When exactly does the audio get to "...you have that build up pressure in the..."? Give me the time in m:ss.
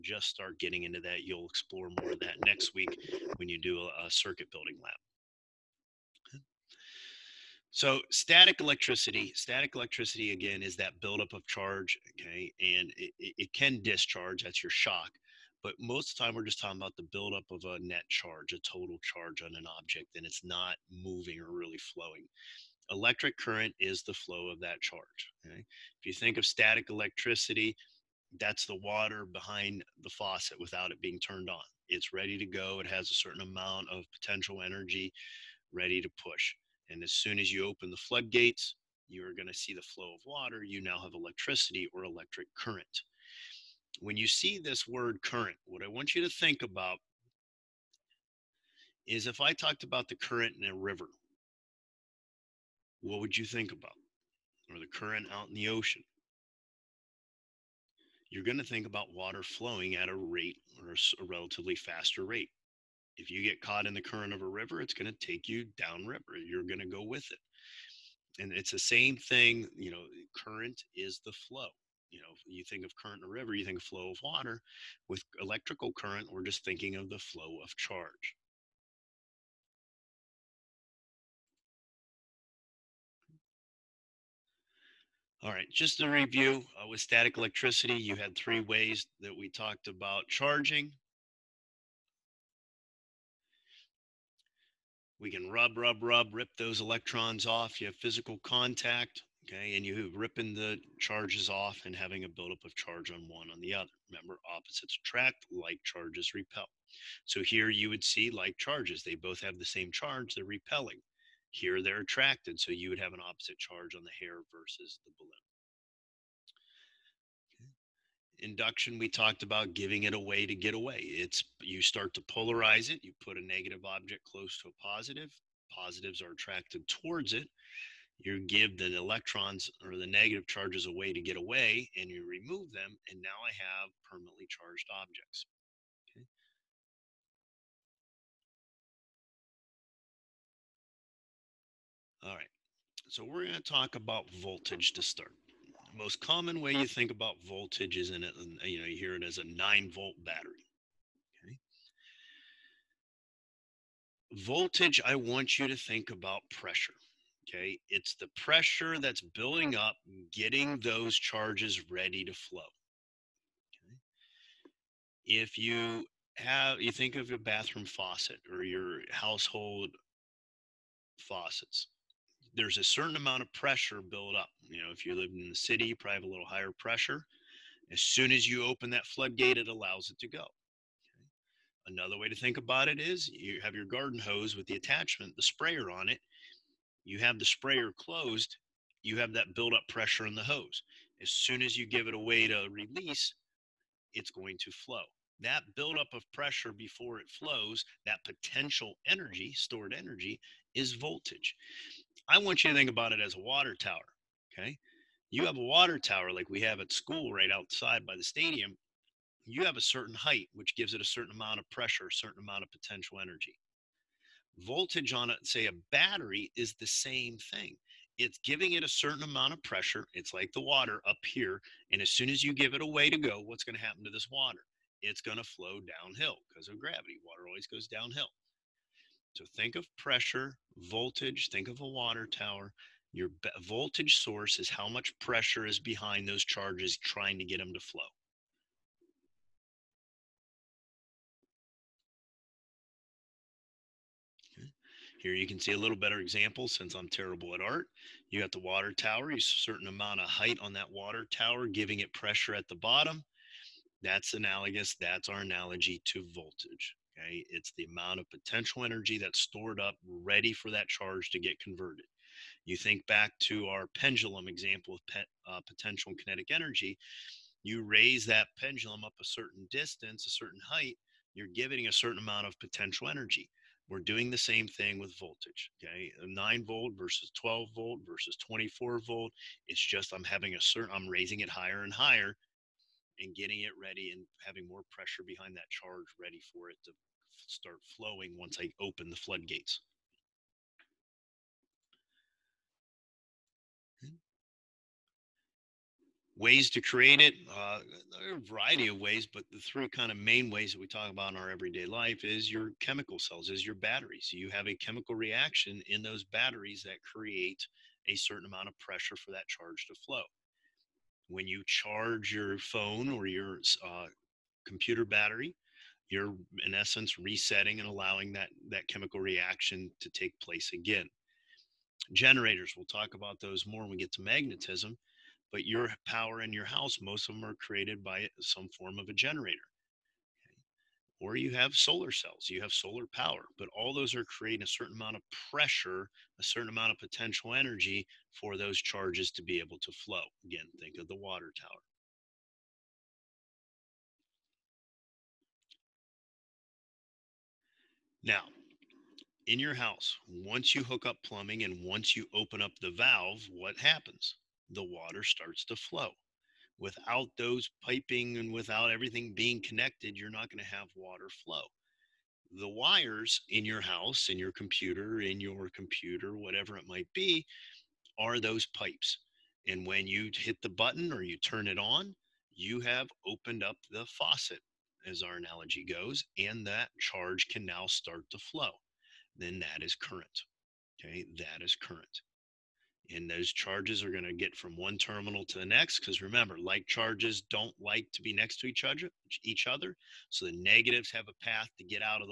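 3:09.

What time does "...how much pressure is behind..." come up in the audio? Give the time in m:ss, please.
3:54.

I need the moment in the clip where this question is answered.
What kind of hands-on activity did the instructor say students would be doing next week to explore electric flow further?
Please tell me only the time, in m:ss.
0:04.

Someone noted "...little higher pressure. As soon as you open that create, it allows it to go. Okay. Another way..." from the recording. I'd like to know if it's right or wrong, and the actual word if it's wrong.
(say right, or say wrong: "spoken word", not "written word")
wrong: "floodgate", not "create".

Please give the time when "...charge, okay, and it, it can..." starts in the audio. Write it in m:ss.
0:11.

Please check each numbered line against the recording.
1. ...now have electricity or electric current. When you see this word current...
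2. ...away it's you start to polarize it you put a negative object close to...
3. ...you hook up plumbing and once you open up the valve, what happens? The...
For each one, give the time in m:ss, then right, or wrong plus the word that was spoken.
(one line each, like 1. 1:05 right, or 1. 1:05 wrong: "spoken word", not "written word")
1. 0:40 right
2. 2:00 right
3. 5:50 right.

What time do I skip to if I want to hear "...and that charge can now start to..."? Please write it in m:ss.
6:16.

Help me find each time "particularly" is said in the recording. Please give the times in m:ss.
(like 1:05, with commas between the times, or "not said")
not said.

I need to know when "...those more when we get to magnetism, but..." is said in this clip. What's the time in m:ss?
5:23.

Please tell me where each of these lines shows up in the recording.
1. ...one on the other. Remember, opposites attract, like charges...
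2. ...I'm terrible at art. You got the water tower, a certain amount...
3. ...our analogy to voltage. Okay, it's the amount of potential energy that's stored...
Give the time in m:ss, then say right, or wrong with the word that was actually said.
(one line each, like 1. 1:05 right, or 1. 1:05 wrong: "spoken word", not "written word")
1. 1:43 right
2. 4:06 right
3. 4:15 right.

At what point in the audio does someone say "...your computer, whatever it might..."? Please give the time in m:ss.
6:05.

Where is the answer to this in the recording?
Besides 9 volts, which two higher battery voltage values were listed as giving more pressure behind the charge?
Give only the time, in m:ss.
4:37.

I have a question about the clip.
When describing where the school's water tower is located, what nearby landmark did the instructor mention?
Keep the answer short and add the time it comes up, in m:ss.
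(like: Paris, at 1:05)
the stadium, at 3:28.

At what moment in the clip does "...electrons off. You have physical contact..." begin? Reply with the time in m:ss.
1:36.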